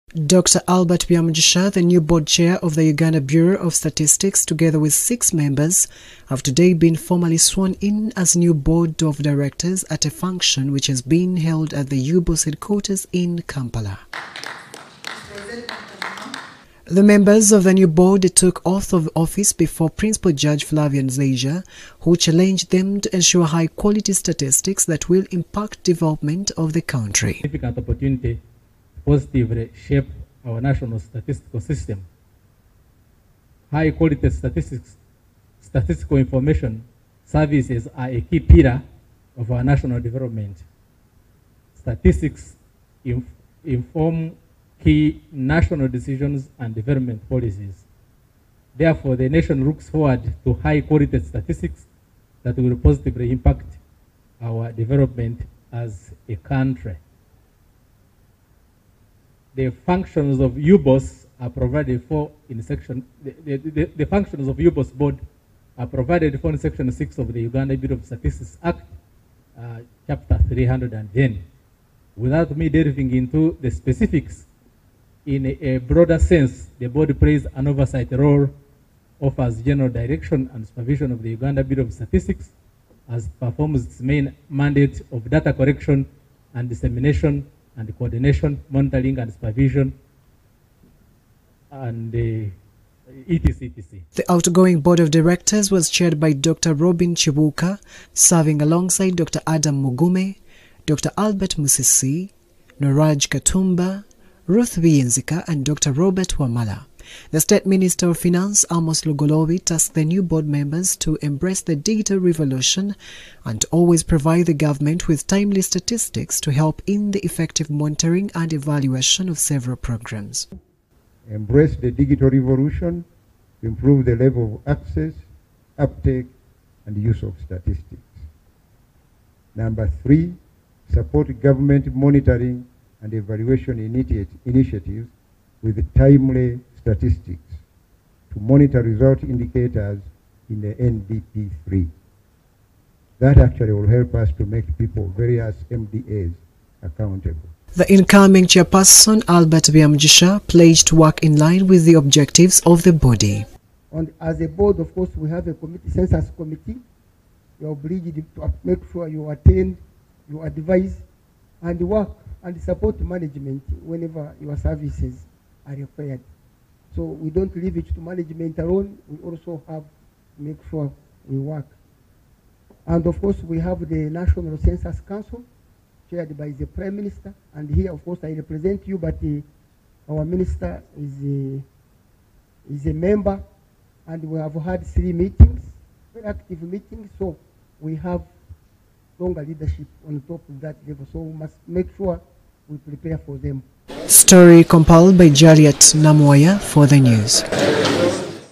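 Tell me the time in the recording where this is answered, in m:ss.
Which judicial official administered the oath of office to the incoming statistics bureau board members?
0:20.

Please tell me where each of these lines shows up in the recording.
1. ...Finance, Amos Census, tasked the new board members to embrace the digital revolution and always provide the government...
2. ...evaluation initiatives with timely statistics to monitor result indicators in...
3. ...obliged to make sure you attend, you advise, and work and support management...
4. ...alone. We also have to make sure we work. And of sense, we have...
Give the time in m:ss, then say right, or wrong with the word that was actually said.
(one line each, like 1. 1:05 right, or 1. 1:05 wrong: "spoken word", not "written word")
1. 1:48 wrong: "Lugoloobi", not "Census"
2. 2:13 right
3. 2:37 right
4. 2:48 wrong: "course", not "sense".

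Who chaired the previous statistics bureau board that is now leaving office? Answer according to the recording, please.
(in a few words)
Dr. Robin Chibuka.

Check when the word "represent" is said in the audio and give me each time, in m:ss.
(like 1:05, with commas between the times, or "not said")
2:58.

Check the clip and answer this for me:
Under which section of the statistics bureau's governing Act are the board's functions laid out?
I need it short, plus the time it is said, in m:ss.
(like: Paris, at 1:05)
Section 6, at 1:06.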